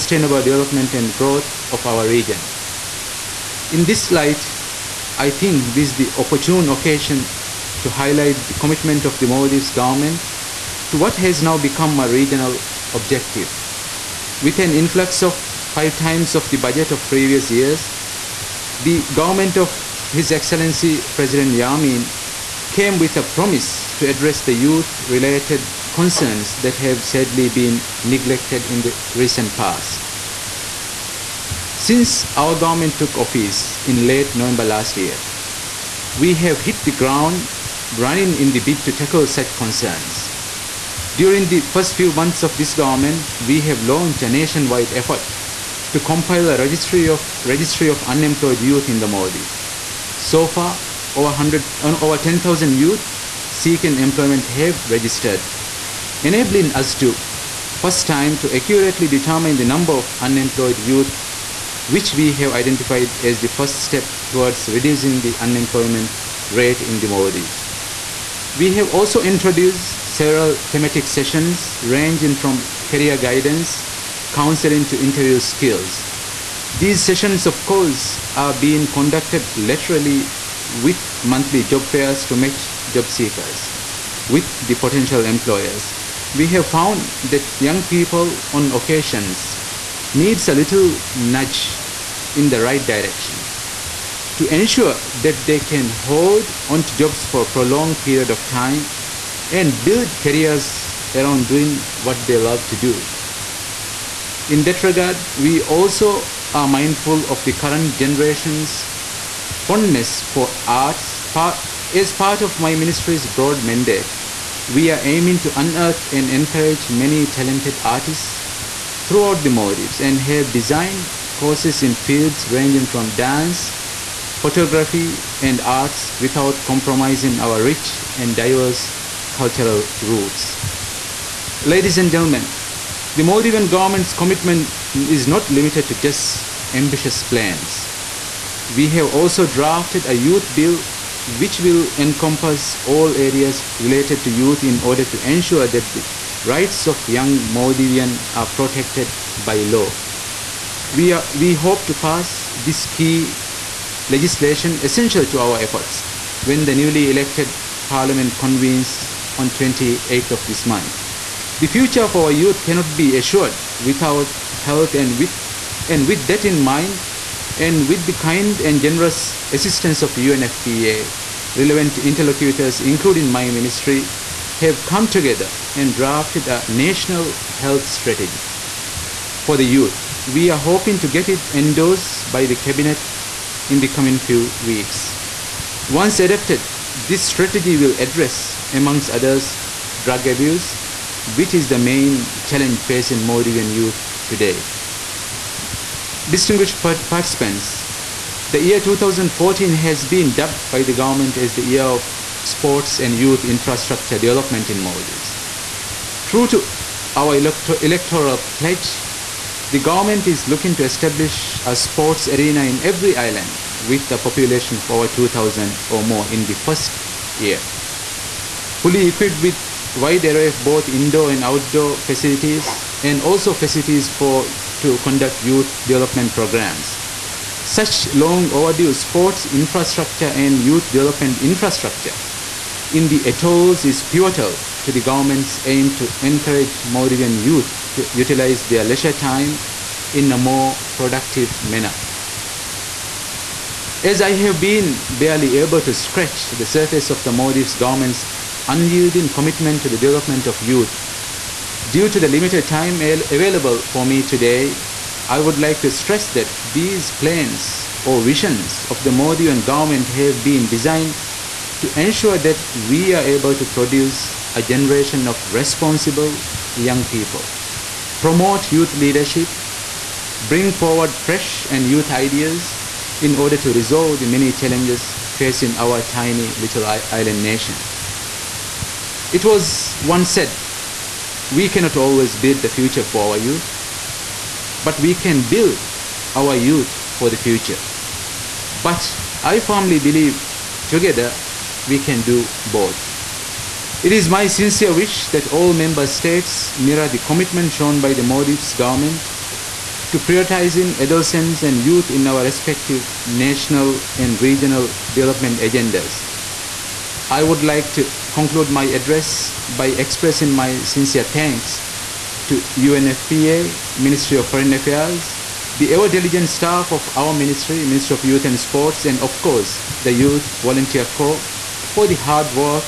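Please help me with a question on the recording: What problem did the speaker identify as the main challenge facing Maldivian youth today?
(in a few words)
drug abuse.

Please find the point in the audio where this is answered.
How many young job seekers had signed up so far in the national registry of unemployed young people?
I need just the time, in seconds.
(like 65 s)
52 s.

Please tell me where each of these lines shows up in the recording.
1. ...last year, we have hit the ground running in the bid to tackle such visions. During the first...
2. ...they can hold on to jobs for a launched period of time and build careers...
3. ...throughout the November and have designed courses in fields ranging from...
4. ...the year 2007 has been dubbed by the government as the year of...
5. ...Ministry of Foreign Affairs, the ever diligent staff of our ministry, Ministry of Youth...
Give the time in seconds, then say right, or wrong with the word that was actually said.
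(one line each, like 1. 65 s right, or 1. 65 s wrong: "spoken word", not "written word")
1. 34 s wrong: "concerns", not "visions"
2. 95 s wrong: "prolonged", not "launched"
3. 119 s wrong: "Maldives", not "November"
4. 198 s wrong: "2014", not "2007"
5. 313 s right.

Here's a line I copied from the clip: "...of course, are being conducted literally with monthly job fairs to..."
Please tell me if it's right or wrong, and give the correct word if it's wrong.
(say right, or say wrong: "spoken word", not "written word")
right.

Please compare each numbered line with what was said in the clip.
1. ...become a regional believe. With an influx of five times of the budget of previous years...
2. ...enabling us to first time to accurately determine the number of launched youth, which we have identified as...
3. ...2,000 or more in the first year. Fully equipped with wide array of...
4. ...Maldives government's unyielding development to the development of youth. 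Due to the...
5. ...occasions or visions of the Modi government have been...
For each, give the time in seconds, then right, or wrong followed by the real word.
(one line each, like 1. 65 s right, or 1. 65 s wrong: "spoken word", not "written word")
1. 11 s wrong: "objective", not "believe"
2. 56 s wrong: "unemployed", not "launched"
3. 215 s right
4. 247 s wrong: "commitment", not "development"
5. 257 s wrong: "plans", not "occasions".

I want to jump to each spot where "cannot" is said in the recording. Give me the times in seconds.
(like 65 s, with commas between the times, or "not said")
162 s, 281 s.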